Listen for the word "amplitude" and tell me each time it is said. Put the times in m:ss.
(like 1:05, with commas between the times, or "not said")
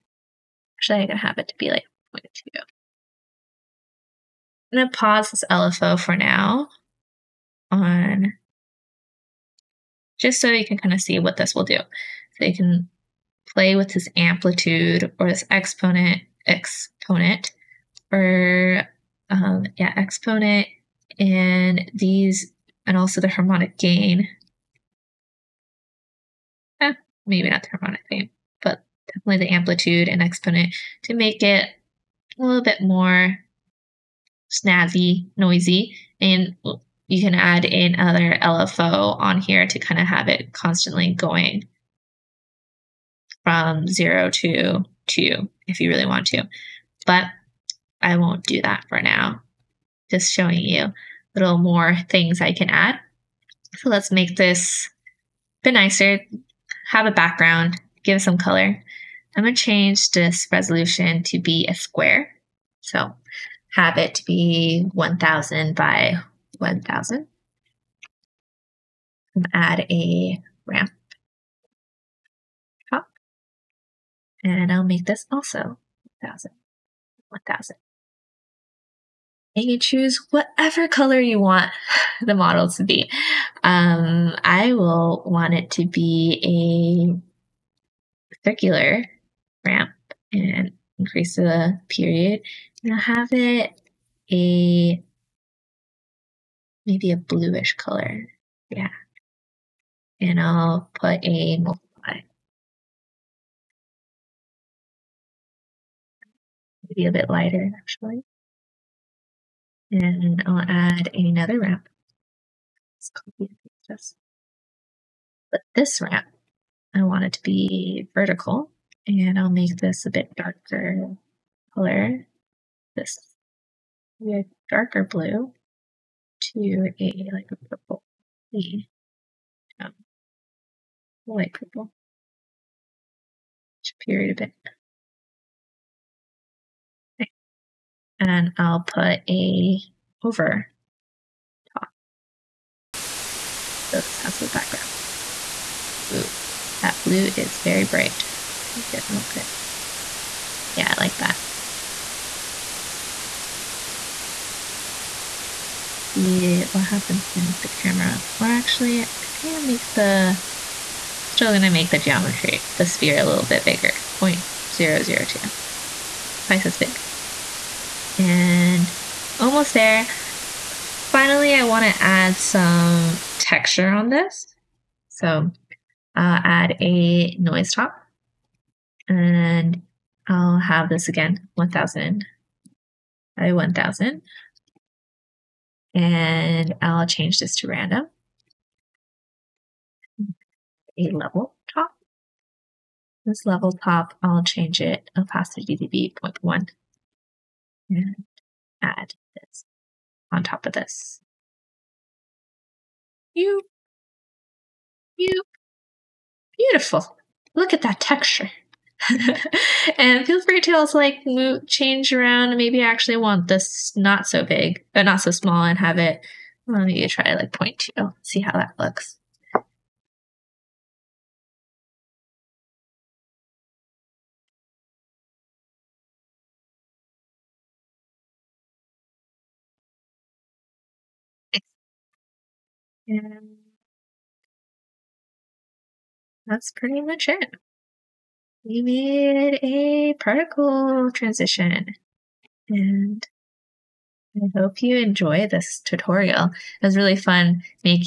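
0:14, 0:29.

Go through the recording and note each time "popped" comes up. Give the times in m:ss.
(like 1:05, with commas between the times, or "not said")
not said.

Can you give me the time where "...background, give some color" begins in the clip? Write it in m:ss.
0:57.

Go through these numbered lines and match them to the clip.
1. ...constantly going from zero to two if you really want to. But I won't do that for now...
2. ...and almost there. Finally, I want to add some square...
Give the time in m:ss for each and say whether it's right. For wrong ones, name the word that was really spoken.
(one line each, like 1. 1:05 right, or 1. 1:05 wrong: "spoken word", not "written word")
1. 0:40 right
2. 2:48 wrong: "texture", not "square".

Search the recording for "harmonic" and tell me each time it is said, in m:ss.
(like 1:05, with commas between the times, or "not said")
0:23, 0:27.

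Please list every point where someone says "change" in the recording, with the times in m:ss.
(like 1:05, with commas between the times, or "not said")
0:59, 3:07, 3:14, 3:31.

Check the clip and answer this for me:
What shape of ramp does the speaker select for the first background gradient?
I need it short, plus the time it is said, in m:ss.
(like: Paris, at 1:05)
circular, at 1:28.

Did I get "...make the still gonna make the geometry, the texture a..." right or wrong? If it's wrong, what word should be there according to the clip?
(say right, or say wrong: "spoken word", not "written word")
wrong: "sphere", not "texture".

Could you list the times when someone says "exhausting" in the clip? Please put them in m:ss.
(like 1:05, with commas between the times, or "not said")
not said.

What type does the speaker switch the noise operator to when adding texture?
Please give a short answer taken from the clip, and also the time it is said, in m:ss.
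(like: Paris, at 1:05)
random, at 3:07.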